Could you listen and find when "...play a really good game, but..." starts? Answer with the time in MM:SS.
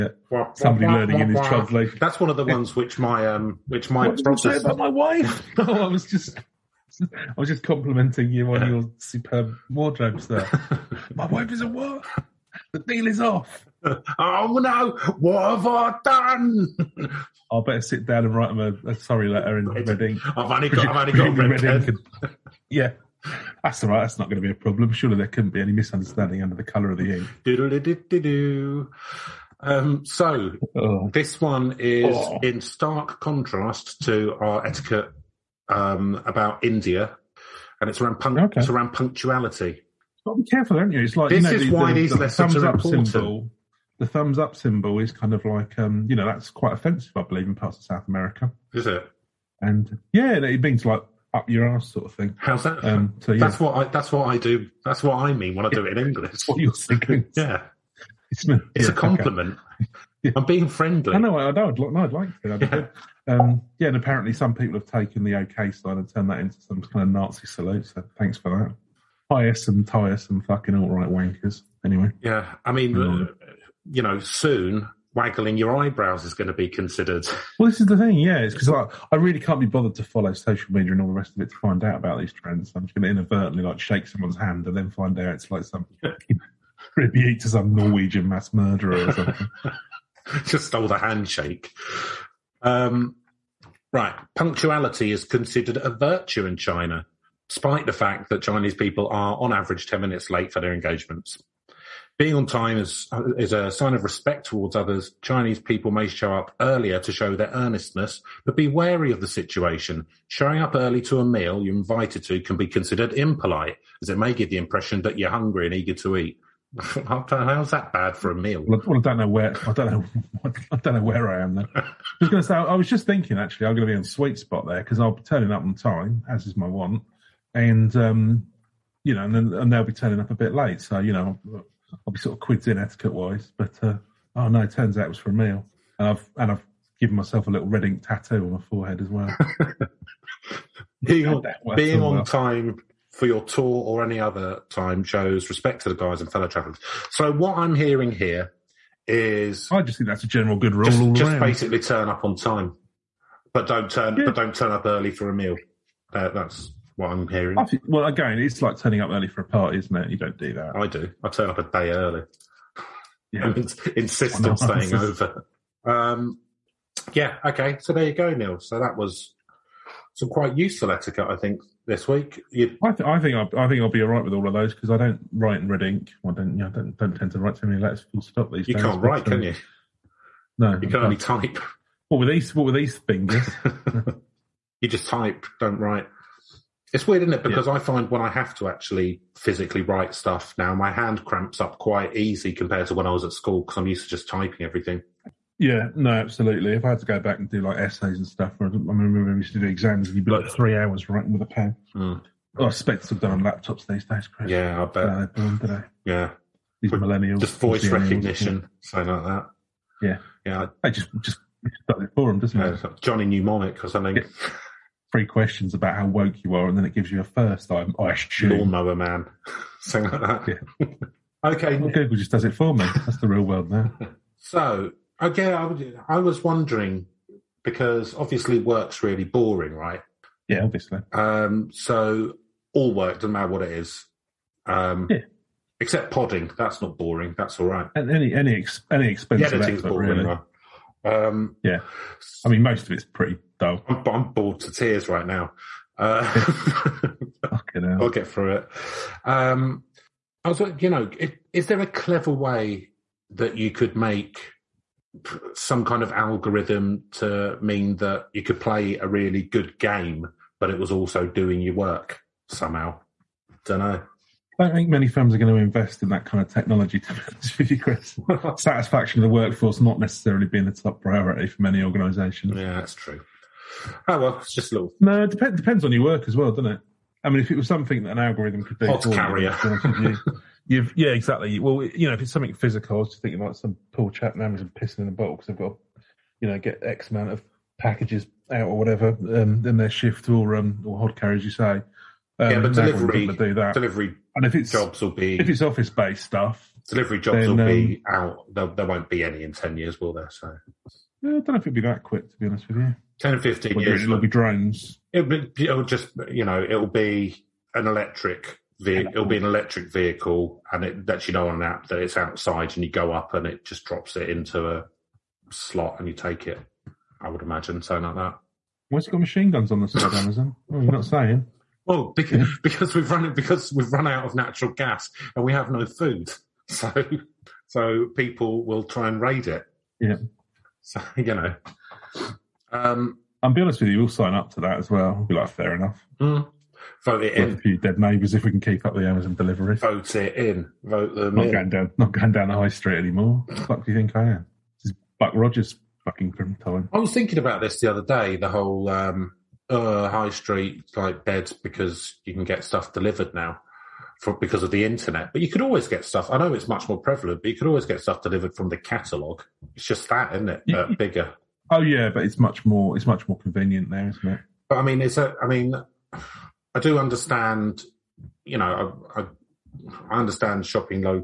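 04:18.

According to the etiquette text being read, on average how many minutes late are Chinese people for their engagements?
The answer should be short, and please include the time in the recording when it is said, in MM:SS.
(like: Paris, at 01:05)
10, at 01:39.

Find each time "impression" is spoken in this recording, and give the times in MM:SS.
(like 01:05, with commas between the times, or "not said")
01:54.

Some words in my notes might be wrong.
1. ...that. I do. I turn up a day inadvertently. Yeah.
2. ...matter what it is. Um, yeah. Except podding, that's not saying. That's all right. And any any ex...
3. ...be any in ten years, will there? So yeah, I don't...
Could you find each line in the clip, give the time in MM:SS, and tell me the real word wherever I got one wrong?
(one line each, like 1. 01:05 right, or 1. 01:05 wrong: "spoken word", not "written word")
1. 02:40 wrong: "early", not "inadvertently"
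2. 03:53 wrong: "boring", not "saying"
3. 04:59 right.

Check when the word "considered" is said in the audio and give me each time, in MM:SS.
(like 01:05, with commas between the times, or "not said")
01:16, 01:35, 01:52.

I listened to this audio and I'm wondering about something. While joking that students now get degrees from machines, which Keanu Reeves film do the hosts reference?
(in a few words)
Johnny Mnemonic.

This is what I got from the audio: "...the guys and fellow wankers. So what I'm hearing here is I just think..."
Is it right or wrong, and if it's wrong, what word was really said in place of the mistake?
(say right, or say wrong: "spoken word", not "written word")
wrong: "travellers", not "wankers".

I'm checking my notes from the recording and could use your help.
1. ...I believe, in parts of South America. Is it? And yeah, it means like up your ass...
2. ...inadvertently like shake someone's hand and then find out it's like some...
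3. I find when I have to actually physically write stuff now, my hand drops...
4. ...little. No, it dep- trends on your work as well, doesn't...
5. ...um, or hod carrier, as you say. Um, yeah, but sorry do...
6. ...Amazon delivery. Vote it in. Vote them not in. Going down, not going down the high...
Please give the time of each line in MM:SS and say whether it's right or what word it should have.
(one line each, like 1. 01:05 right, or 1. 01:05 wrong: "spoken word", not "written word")
1. 00:47 right
2. 01:23 right
3. 03:07 wrong: "cramps", not "drops"
4. 04:34 wrong: "depends", not "trends"
5. 04:50 wrong: "delivery", not "sorry"
6. 05:39 right.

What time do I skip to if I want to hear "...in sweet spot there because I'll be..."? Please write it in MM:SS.
02:03.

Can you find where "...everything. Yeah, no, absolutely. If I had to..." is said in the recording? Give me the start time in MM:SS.
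03:14.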